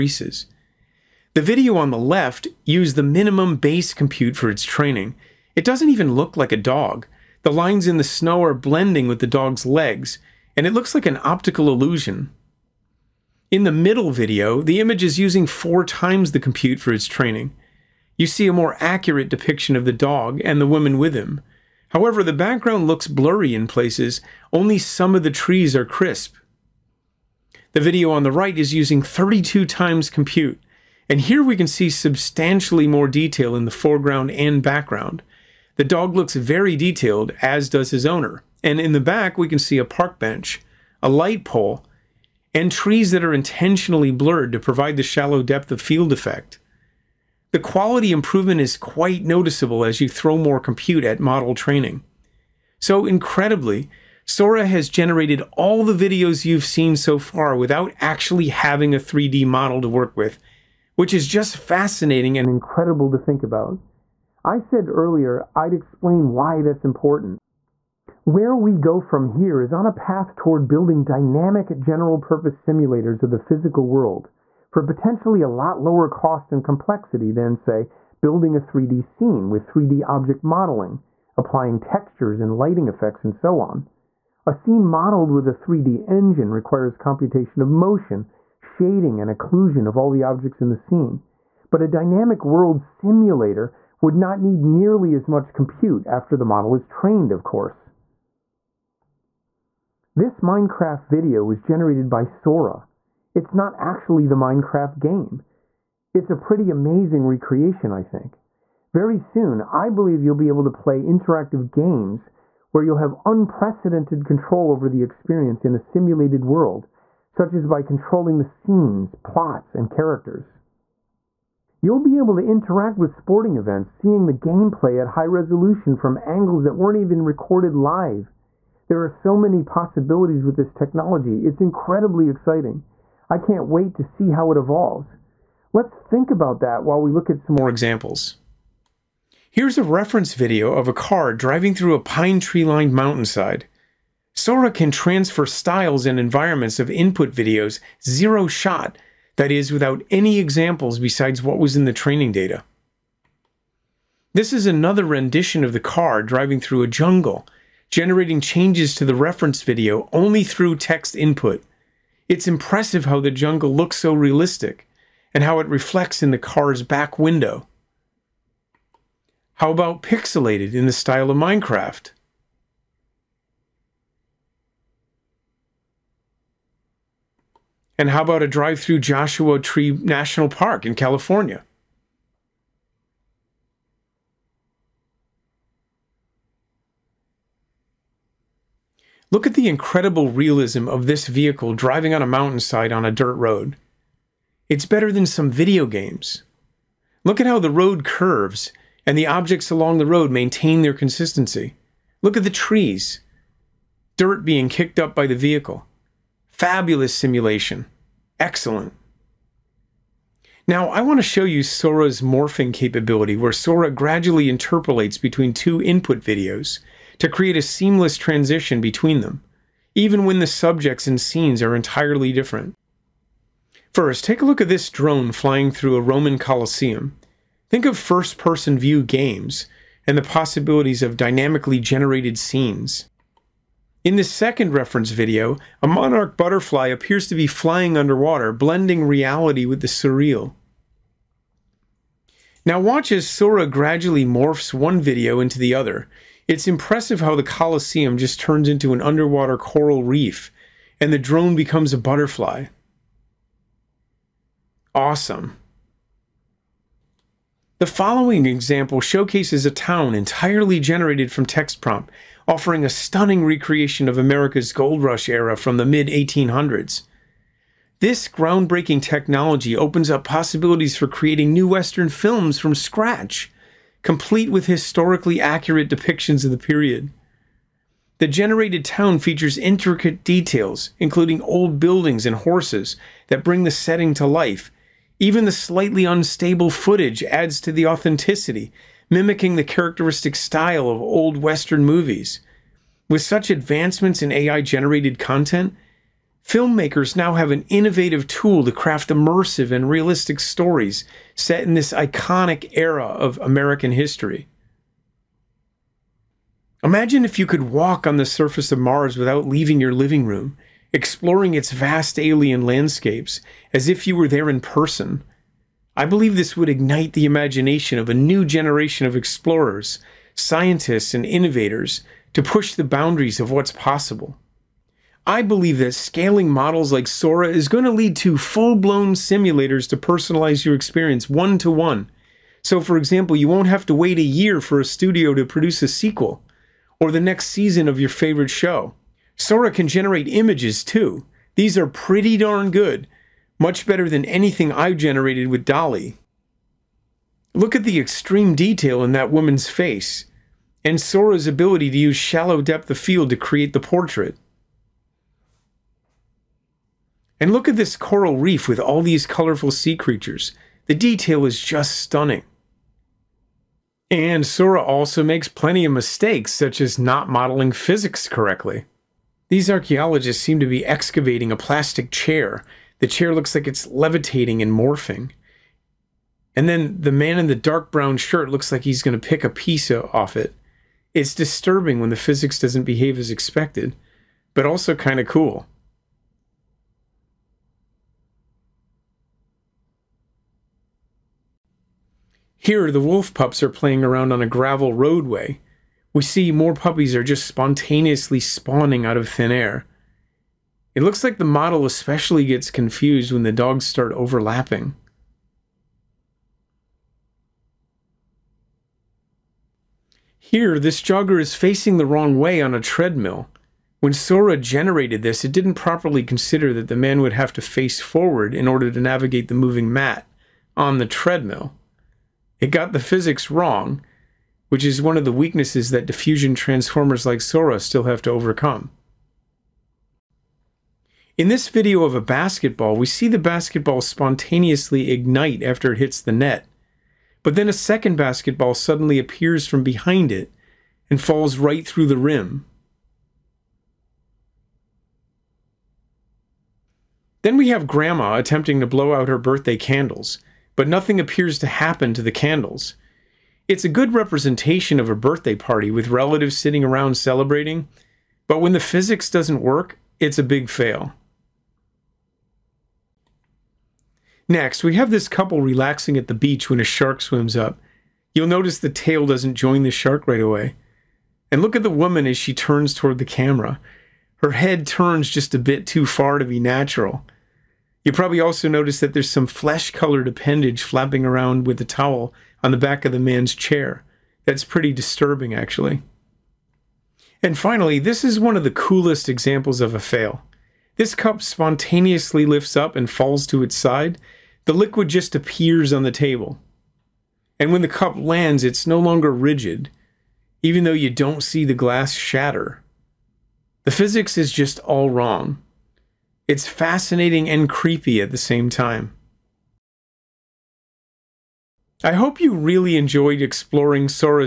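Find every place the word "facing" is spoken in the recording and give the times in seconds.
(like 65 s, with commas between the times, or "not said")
411 s.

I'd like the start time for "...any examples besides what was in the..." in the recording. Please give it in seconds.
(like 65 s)
150 s.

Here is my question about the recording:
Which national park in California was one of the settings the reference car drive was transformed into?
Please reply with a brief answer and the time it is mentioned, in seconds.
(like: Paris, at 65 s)
Joshua Tree National Park, at 178 s.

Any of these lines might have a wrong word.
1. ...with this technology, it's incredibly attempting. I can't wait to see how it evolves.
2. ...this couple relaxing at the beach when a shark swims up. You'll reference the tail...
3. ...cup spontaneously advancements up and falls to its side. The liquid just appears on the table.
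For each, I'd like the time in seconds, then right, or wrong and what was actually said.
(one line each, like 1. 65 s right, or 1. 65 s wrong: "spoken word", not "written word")
1. 130 s wrong: "exciting", not "attempting"
2. 465 s wrong: "notice", not "reference"
3. 491 s wrong: "lifts", not "advancements".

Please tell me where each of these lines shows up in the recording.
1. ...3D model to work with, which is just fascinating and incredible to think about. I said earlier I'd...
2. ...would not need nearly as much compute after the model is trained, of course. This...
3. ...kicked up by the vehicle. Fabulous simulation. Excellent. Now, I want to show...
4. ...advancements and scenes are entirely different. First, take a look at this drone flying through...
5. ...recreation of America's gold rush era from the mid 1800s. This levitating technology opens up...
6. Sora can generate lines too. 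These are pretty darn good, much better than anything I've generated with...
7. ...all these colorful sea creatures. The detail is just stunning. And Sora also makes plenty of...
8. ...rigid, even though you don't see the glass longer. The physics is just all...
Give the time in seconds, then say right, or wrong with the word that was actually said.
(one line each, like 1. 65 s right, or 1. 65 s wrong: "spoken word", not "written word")
1. 58 s right
2. 94 s right
3. 204 s right
4. 220 s wrong: "subjects", not "advancements"
5. 263 s wrong: "groundbreaking", not "levitating"
6. 339 s wrong: "images", not "lines"
7. 358 s right
8. 499 s wrong: "shatter", not "longer".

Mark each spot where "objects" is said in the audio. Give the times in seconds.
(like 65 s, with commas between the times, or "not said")
80 s, 90 s, 199 s.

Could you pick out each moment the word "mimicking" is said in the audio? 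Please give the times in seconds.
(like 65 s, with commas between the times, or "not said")
289 s.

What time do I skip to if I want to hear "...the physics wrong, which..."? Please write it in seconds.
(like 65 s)
422 s.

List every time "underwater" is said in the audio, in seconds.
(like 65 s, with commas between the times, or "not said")
237 s, 249 s.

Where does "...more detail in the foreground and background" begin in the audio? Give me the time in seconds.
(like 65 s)
32 s.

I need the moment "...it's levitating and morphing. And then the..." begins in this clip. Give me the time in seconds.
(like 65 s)
373 s.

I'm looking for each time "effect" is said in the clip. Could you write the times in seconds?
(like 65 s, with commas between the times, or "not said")
46 s, 82 s.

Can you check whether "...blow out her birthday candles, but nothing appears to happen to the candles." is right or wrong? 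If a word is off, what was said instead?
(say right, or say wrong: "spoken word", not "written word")
right.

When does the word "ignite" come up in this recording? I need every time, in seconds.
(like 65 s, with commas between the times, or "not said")
316 s, 435 s.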